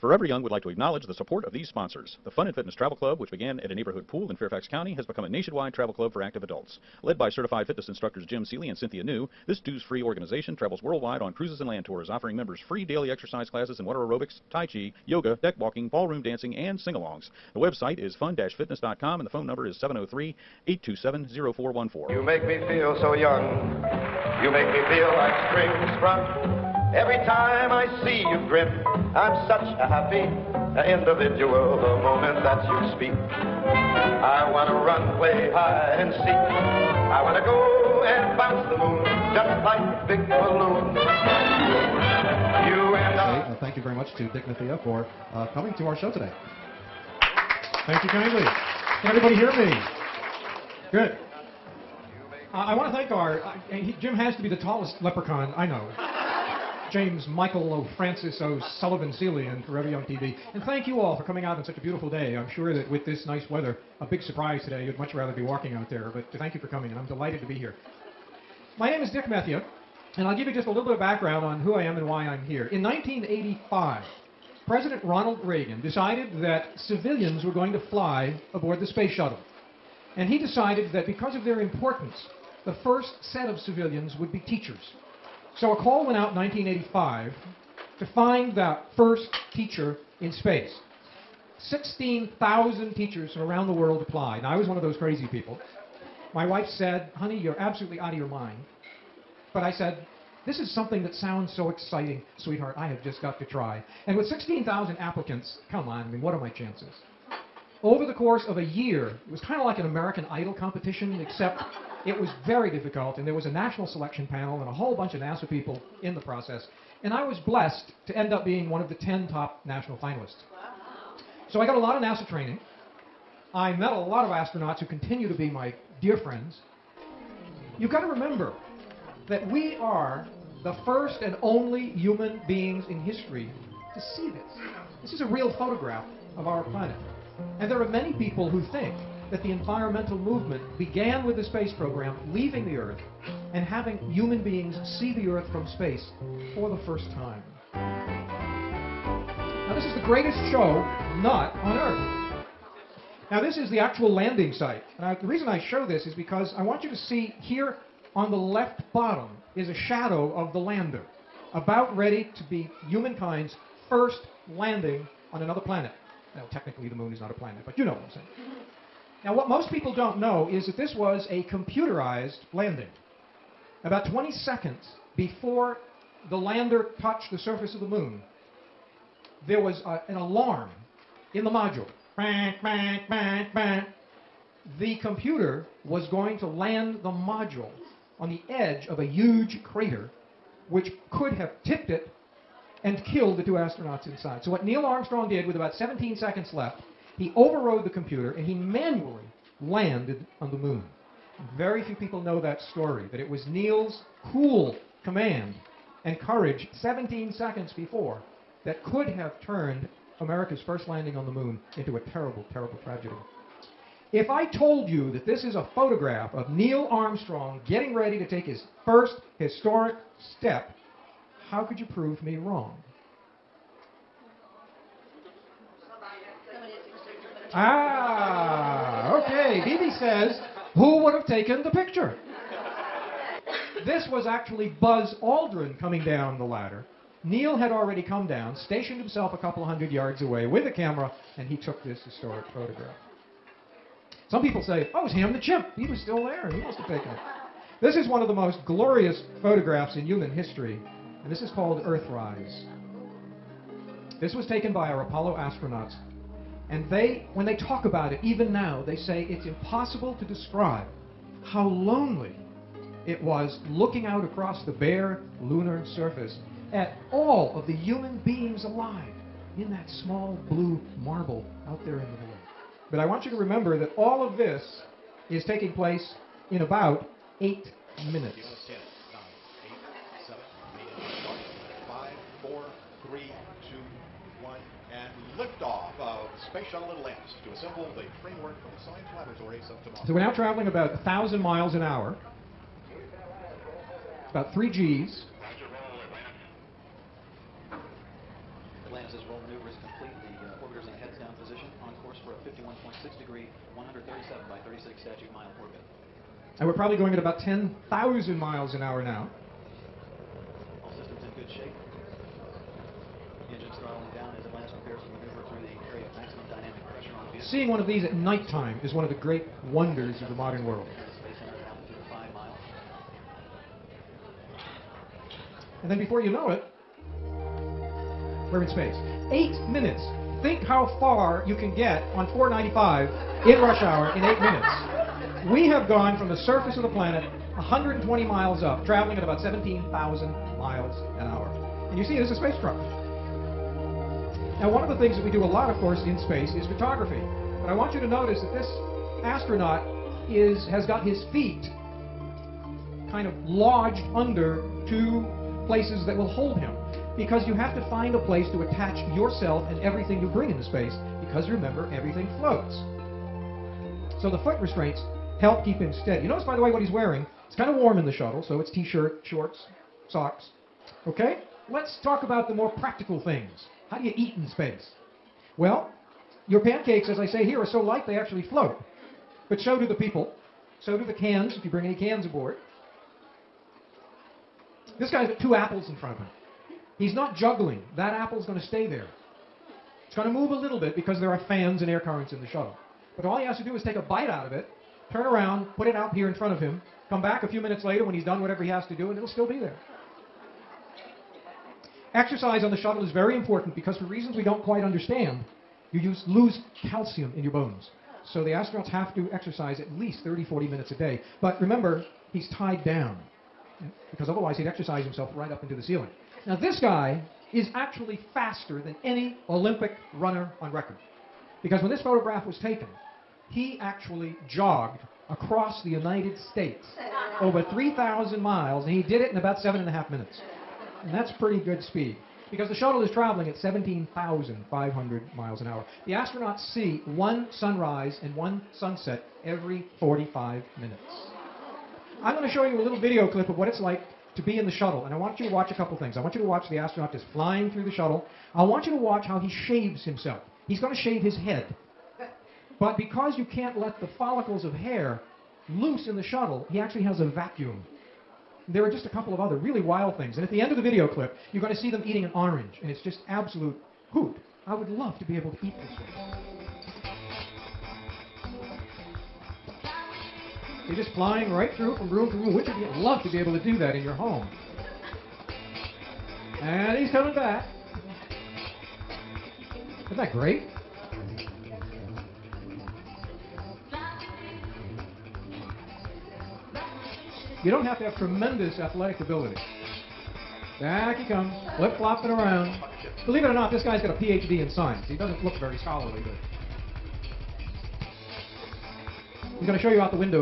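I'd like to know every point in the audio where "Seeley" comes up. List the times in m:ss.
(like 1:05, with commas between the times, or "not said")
0:08, 0:58.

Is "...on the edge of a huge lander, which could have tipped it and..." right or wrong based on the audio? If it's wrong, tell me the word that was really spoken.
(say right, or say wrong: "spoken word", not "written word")
wrong: "crater", not "lander".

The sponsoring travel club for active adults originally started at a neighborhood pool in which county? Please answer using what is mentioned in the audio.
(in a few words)
Fairfax County.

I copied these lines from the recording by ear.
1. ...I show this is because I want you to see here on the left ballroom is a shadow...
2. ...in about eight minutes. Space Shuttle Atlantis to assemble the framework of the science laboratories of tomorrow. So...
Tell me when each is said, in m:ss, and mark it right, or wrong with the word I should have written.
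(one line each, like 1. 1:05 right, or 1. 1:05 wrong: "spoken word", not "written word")
1. 2:35 wrong: "bottom", not "ballroom"
2. 4:36 right.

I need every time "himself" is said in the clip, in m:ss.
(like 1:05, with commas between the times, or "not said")
3:59, 6:55, 7:30.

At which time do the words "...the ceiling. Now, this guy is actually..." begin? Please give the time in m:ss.
6:55.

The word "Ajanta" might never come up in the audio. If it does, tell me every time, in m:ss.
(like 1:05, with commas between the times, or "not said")
not said.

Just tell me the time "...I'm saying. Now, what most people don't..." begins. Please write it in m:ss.
2:47.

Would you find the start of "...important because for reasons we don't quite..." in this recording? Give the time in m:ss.
6:43.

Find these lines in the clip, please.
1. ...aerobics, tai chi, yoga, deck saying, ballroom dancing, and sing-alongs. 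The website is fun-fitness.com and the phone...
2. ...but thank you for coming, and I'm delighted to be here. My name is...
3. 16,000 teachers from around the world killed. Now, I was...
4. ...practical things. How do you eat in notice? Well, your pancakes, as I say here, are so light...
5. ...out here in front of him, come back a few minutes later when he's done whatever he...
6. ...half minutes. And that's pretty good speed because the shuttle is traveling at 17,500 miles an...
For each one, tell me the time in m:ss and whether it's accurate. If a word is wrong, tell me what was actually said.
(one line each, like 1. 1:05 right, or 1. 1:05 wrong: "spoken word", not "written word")
1. 0:13 wrong: "walking", not "saying"
2. 1:06 right
3. 1:31 wrong: "applied", not "killed"
4. 6:12 wrong: "space", not "notice"
5. 6:35 right
6. 7:09 right.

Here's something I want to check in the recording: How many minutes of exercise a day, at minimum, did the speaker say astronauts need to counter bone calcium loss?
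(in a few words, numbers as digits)
30 to 40 minutes.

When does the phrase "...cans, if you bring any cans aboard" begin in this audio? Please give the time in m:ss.
6:21.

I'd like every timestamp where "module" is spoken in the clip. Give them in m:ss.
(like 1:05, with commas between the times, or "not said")
3:01, 3:07.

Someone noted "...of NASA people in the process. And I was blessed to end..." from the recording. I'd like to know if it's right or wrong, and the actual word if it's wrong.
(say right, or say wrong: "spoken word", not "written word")
right.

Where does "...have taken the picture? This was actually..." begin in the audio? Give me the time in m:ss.
3:51.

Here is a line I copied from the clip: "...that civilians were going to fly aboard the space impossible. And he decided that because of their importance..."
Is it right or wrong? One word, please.
wrong.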